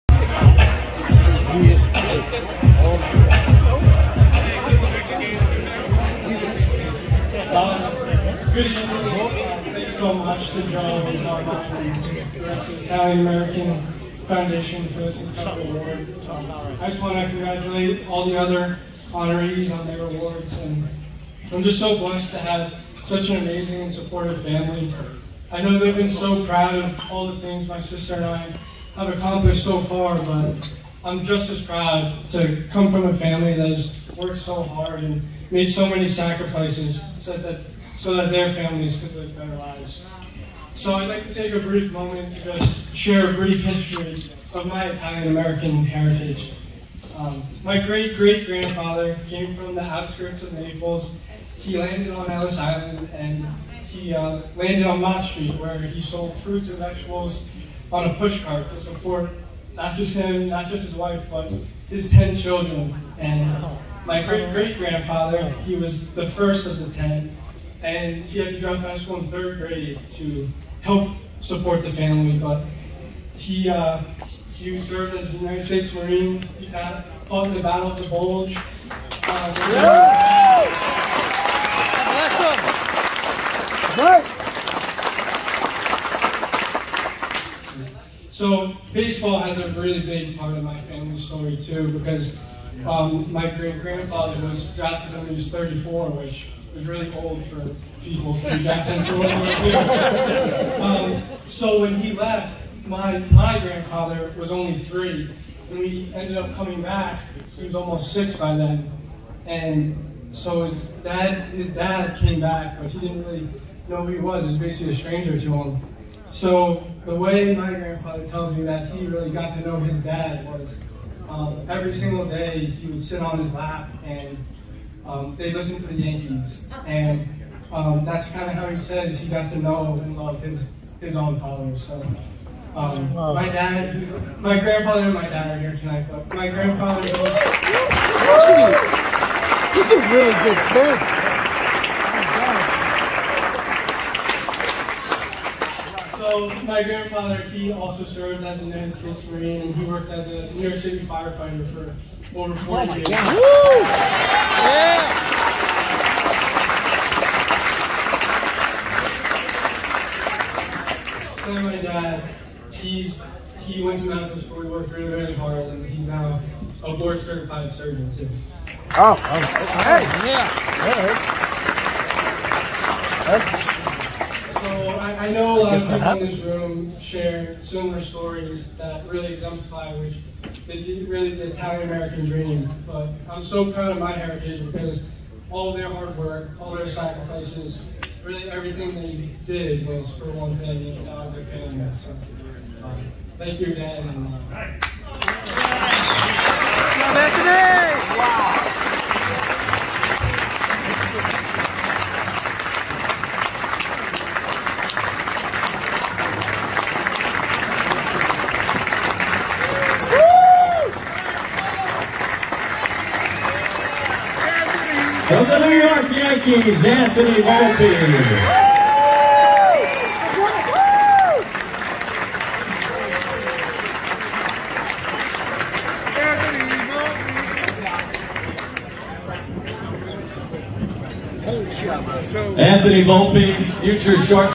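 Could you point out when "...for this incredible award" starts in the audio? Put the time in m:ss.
0:14.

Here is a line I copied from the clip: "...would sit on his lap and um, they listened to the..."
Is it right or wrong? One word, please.
right.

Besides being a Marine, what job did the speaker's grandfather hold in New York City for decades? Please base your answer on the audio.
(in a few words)
firefighter.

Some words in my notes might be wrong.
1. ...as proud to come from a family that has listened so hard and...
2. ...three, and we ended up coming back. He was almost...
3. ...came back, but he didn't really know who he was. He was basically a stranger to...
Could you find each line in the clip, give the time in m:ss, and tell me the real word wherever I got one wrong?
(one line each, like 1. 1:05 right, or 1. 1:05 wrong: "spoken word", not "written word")
1. 0:31 wrong: "worked", not "listened"
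2. 1:44 right
3. 1:52 right.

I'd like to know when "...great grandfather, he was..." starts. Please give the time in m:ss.
1:04.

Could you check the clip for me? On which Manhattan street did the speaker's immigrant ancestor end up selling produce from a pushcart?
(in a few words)
Mott Street.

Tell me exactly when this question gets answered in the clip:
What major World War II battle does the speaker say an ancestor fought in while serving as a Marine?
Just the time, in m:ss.
1:17.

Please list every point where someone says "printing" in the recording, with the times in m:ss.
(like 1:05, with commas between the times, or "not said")
not said.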